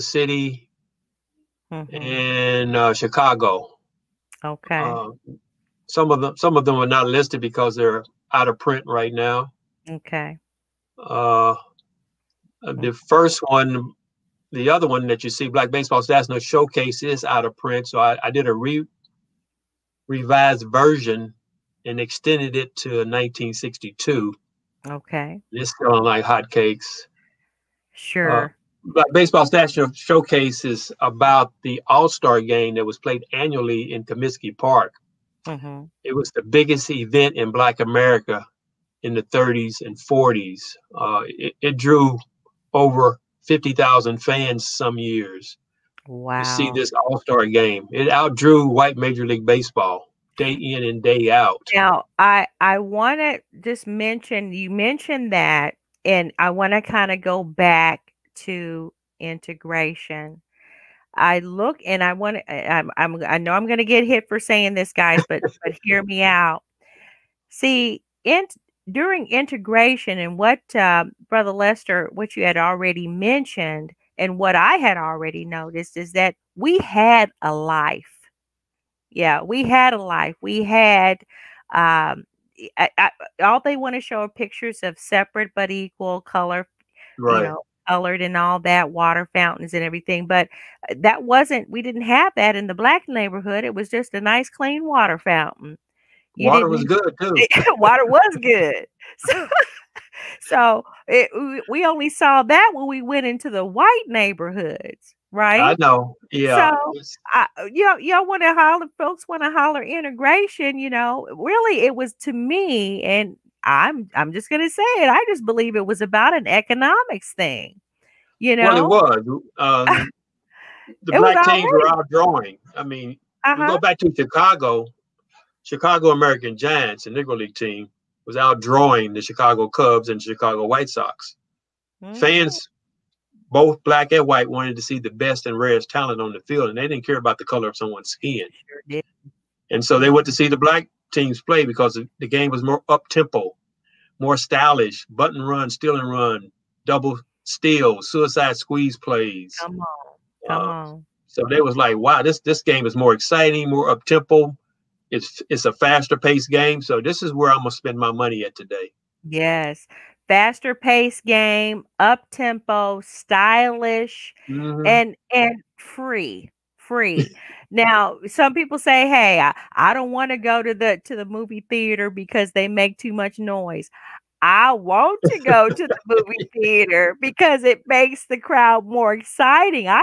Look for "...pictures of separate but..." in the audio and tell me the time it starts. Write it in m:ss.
1:24.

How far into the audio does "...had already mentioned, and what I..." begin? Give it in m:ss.
1:12.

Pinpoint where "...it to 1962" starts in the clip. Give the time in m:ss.
0:22.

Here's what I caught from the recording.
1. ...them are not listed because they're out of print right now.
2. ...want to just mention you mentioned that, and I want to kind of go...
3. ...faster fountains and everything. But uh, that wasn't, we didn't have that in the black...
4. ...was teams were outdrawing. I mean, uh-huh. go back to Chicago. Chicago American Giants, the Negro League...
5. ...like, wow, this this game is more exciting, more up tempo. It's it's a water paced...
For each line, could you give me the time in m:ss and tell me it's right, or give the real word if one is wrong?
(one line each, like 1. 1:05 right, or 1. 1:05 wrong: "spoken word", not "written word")
1. 0:06 right
2. 0:52 right
3. 1:28 wrong: "water", not "faster"
4. 2:01 right
5. 2:31 wrong: "faster", not "water".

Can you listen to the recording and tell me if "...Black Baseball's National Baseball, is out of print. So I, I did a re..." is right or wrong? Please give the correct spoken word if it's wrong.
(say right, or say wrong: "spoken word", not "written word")
wrong: "Showcase", not "Baseball".